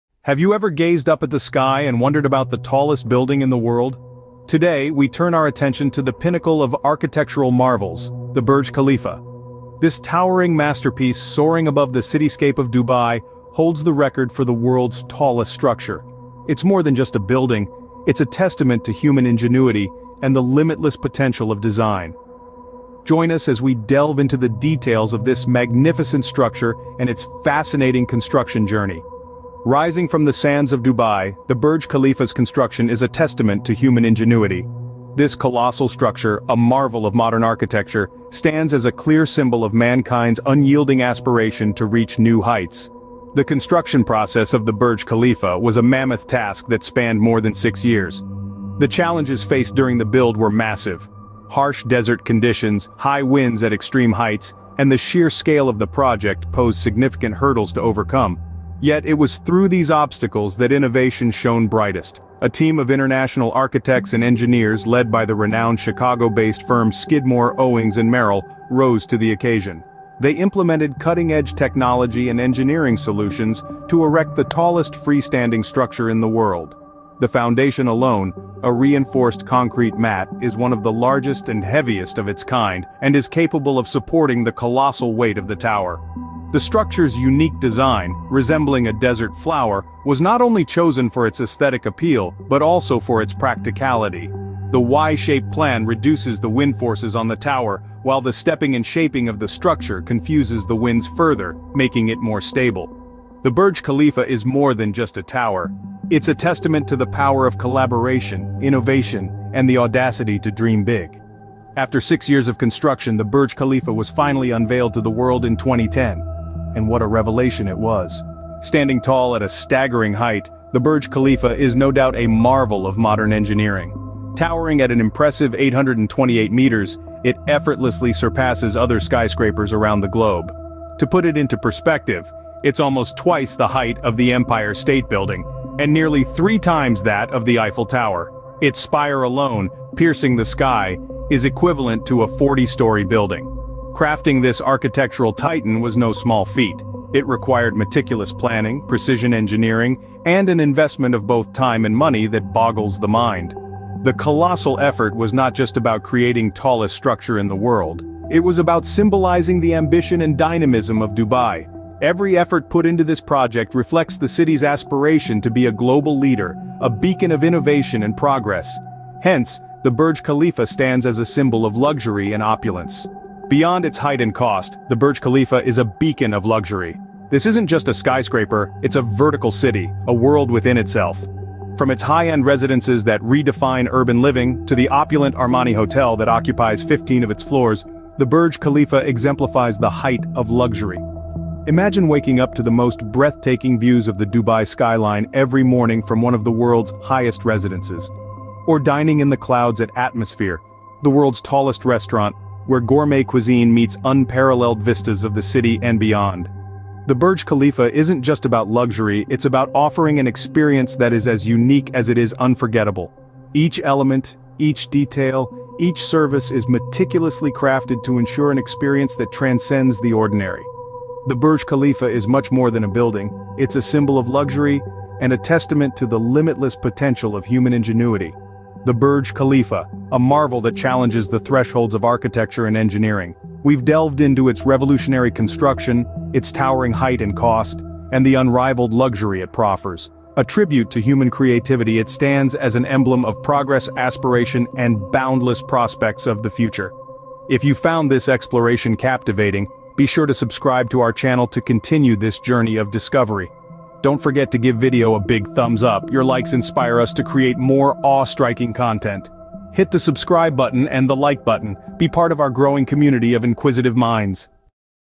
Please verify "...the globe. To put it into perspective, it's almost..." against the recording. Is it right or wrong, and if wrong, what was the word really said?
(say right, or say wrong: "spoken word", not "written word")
right.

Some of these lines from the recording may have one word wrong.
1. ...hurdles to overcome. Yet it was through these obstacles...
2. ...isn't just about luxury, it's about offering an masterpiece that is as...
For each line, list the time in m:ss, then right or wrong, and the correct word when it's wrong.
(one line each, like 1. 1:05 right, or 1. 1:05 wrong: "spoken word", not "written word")
1. 0:57 right
2. 3:27 wrong: "experience", not "masterpiece".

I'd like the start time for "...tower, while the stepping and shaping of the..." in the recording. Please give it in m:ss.
1:37.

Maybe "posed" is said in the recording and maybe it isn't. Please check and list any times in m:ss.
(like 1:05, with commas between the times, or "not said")
0:56.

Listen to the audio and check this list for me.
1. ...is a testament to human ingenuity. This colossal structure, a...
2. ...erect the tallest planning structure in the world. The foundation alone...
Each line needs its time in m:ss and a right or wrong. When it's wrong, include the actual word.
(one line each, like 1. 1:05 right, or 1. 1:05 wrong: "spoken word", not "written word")
1. 0:32 right
2. 1:14 wrong: "freestanding", not "planning".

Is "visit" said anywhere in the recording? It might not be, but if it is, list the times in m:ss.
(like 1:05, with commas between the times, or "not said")
not said.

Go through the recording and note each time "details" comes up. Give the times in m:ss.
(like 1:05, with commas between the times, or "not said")
0:24, 3:34.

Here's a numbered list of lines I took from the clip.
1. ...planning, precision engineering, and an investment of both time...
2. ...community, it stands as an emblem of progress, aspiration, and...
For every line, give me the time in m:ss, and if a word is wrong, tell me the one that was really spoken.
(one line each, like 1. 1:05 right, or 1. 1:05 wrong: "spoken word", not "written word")
1. 2:28 right
2. 4:01 wrong: "creativity", not "community".